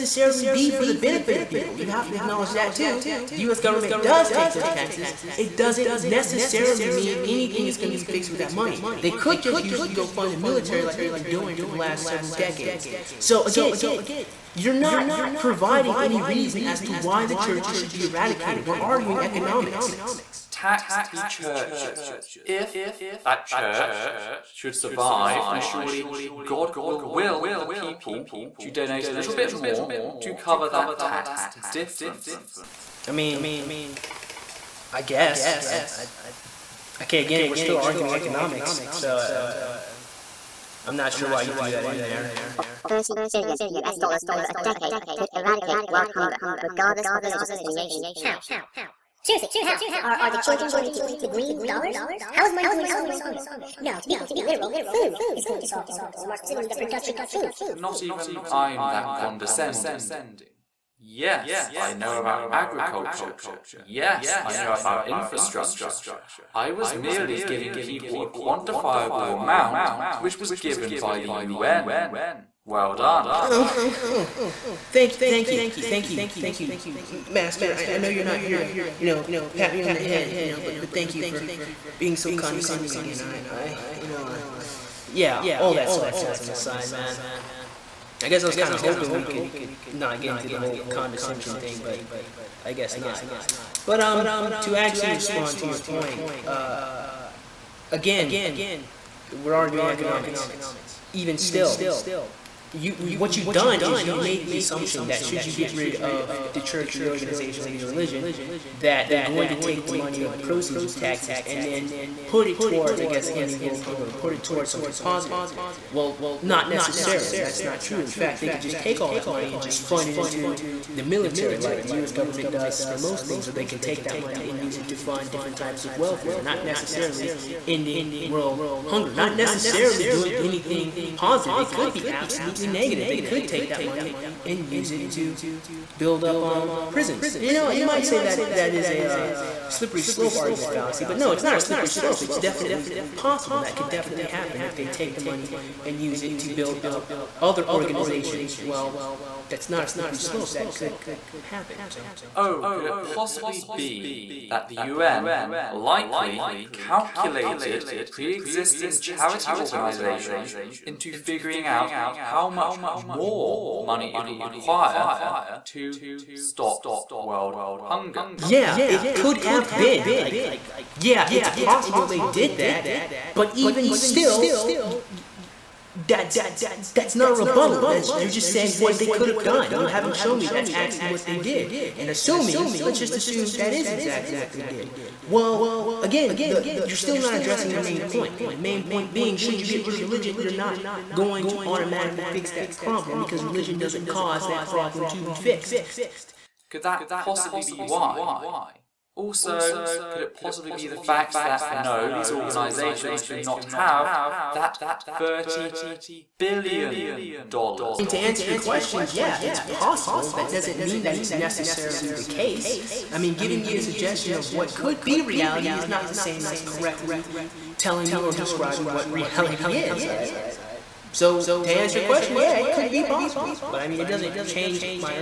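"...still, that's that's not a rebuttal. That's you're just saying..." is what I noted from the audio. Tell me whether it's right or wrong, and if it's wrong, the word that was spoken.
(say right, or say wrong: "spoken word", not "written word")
right.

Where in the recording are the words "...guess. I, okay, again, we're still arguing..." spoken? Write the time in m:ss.
0:35.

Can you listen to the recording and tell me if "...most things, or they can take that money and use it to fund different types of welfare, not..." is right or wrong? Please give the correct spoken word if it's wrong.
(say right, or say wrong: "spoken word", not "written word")
right.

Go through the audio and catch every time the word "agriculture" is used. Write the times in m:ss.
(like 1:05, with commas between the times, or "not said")
1:02.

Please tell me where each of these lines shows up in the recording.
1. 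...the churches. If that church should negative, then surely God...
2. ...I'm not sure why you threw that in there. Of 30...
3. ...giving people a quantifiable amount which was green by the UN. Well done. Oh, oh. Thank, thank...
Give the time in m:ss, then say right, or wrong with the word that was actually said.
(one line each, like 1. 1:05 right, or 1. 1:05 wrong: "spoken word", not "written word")
1. 0:21 wrong: "survive", not "negative"
2. 0:40 right
3. 1:07 wrong: "given", not "green".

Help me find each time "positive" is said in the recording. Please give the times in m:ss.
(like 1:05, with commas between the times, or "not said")
1:55, 2:11.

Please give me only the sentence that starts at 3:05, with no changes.
Well, again, the, you're still not addressing the main point.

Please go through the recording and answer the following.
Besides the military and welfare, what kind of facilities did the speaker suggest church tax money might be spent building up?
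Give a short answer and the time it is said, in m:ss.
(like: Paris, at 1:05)
Prisons, at 2:16.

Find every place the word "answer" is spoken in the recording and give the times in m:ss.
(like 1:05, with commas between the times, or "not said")
3:28, 3:41.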